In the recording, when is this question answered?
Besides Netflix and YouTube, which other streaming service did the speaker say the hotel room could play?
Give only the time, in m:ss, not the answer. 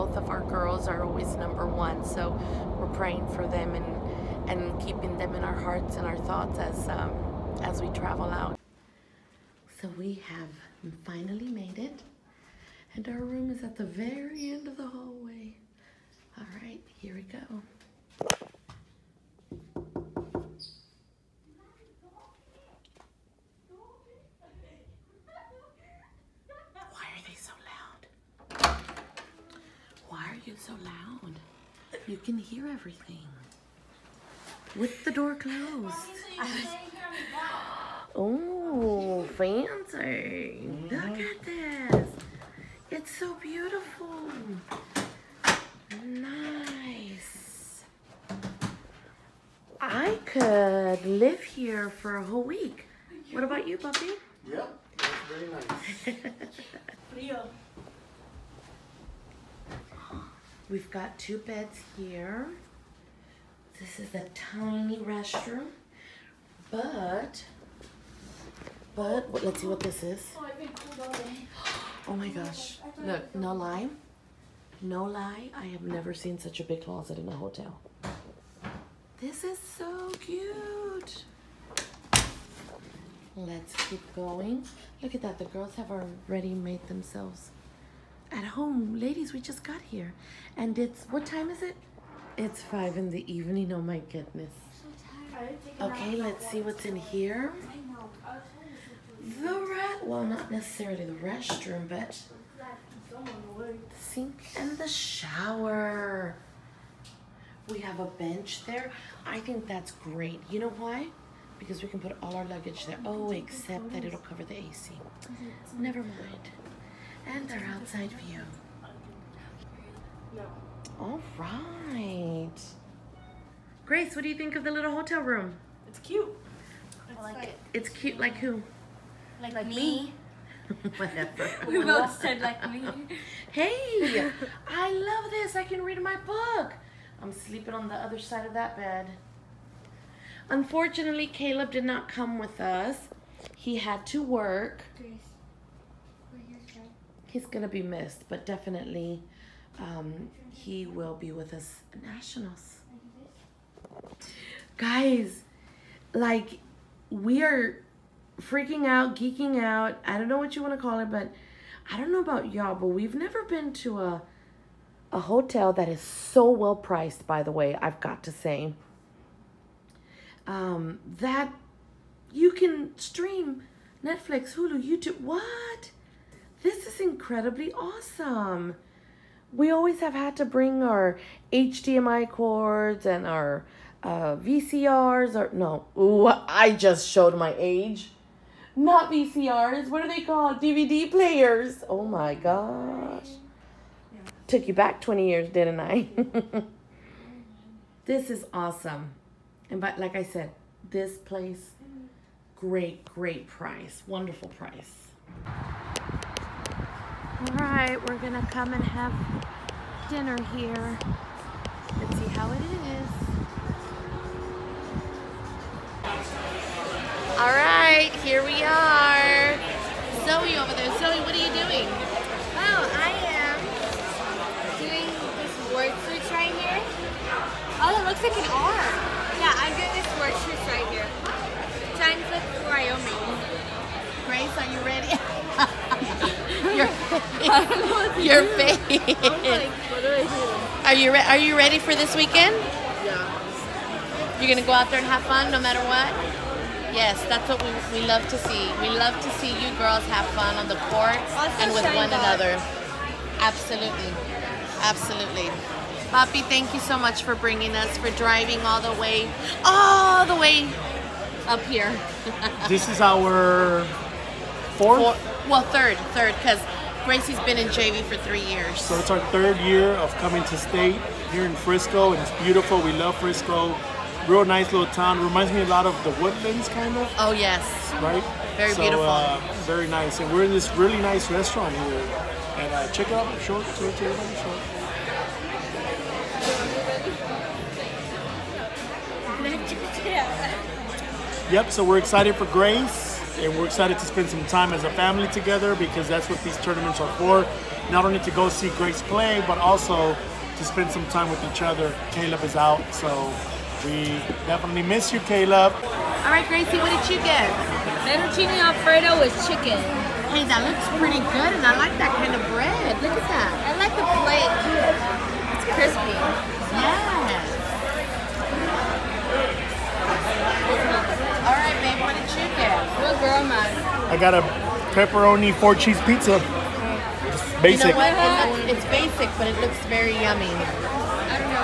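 2:54.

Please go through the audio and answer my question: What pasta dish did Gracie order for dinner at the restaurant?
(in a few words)
Fettuccine Alfredo with chicken.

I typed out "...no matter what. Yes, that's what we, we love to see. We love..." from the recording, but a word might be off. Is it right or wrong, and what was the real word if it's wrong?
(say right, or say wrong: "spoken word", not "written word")
right.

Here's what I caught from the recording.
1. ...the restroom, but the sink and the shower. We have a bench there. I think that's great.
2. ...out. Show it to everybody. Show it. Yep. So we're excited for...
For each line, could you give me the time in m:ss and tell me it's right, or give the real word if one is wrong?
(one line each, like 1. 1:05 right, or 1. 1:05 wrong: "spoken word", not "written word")
1. 1:41 right
2. 4:43 right.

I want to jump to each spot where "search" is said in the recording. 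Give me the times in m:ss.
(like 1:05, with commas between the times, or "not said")
3:46, 3:50.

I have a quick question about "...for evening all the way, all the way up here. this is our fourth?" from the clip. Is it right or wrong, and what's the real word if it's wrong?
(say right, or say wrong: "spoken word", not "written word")
wrong: "driving", not "evening".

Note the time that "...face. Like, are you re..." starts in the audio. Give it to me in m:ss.
3:58.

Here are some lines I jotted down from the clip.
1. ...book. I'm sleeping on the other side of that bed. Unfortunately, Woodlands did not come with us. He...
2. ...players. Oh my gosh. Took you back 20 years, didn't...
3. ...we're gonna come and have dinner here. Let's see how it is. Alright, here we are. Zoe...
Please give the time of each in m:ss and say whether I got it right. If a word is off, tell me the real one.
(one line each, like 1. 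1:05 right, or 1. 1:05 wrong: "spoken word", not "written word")
1. 2:16 wrong: "Caleb", not "Woodlands"
2. 3:11 right
3. 3:28 right.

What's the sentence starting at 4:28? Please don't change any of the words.
So it's our third year of coming to state here in Frisco, and it's beautiful.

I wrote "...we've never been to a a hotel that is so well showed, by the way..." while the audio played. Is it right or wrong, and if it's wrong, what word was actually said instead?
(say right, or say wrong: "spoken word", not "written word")
wrong: "priced", not "showed".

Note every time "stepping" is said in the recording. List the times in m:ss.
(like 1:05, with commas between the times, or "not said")
not said.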